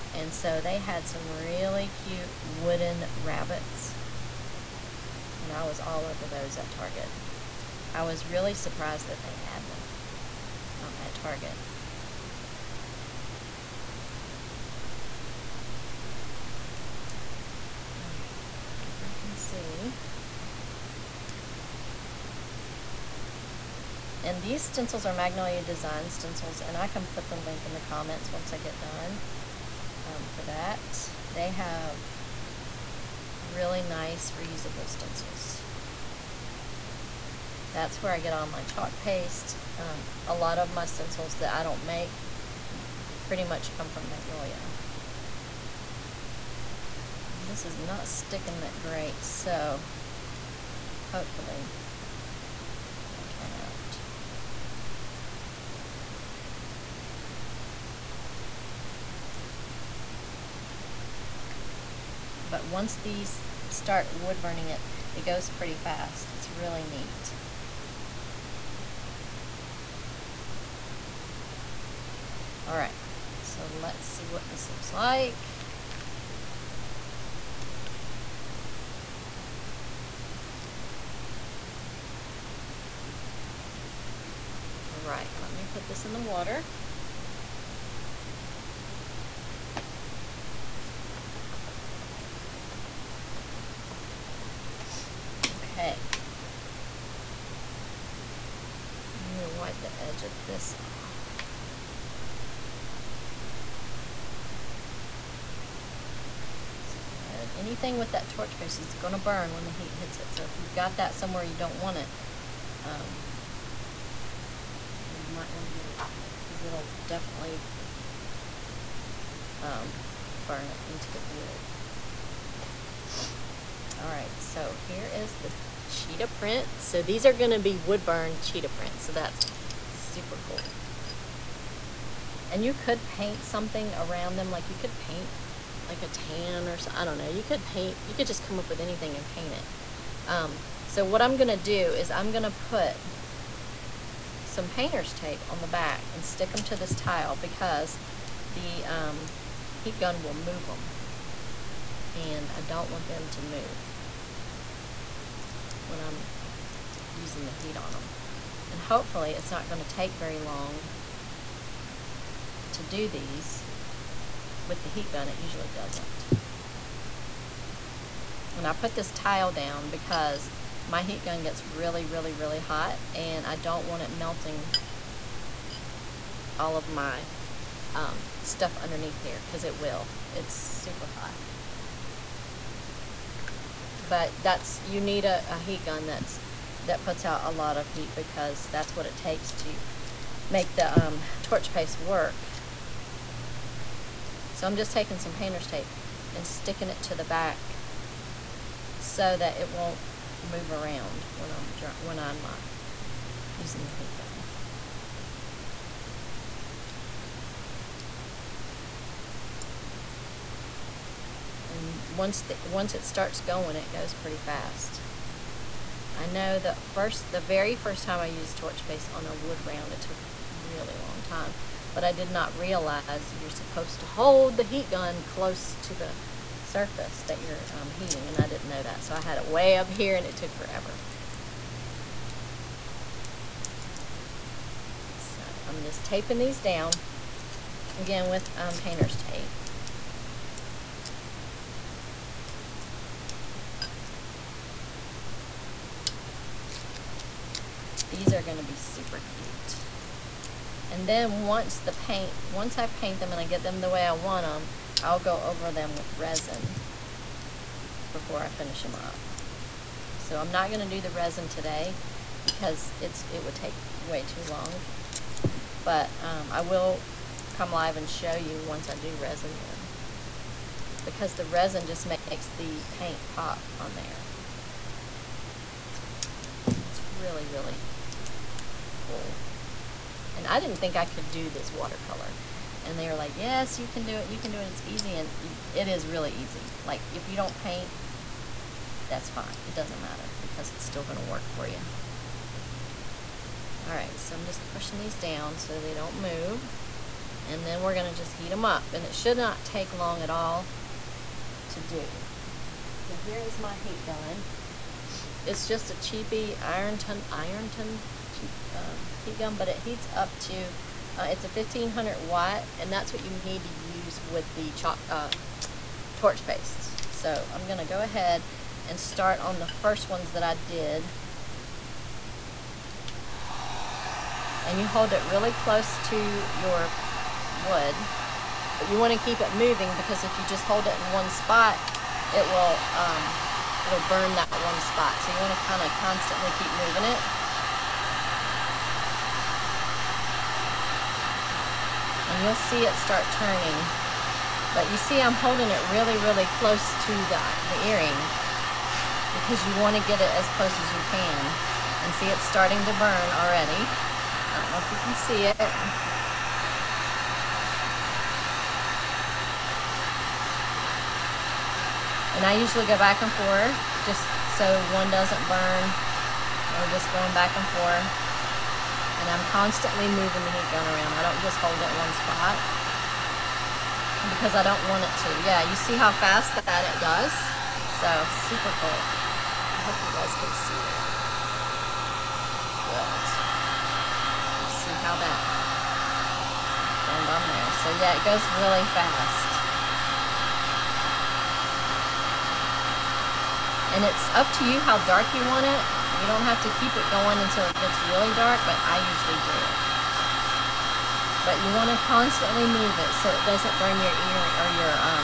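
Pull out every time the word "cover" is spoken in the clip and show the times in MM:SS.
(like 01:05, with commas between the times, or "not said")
not said.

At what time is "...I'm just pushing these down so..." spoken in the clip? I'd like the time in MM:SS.
04:54.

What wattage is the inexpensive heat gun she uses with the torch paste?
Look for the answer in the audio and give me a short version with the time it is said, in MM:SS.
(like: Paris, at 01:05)
1500 watt, at 05:11.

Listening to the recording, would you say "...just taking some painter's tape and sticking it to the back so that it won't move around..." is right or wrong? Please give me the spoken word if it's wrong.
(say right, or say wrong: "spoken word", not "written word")
right.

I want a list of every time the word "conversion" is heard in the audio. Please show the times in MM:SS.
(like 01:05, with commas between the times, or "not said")
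not said.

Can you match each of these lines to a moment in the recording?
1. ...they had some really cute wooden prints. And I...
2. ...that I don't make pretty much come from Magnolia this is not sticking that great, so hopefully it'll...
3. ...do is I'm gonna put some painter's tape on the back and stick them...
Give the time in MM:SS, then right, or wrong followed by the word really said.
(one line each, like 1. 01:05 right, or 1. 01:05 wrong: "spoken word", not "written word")
1. 00:00 wrong: "rabbits", not "prints"
2. 00:41 right
3. 02:21 right.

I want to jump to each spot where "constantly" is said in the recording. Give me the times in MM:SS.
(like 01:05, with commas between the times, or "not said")
05:36, 06:09, 06:42.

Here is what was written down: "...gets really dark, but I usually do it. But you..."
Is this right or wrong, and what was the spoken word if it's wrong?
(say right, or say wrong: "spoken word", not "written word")
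right.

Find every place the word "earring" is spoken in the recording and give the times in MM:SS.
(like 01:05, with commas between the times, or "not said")
05:47.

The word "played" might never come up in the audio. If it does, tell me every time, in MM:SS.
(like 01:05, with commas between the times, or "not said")
not said.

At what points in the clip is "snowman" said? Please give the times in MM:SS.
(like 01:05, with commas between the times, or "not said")
not said.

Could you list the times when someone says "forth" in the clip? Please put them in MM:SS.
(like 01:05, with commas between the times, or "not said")
06:03, 06:07.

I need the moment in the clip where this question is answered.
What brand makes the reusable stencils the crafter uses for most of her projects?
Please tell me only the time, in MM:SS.
00:25.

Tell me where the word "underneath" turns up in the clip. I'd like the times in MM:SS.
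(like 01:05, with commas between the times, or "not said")
02:58.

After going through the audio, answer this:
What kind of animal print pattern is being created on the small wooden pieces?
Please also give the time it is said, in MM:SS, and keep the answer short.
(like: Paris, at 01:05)
Cheetah print, at 02:05.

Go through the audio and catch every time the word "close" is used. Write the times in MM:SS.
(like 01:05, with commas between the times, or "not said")
03:45, 05:25, 05:46, 05:50.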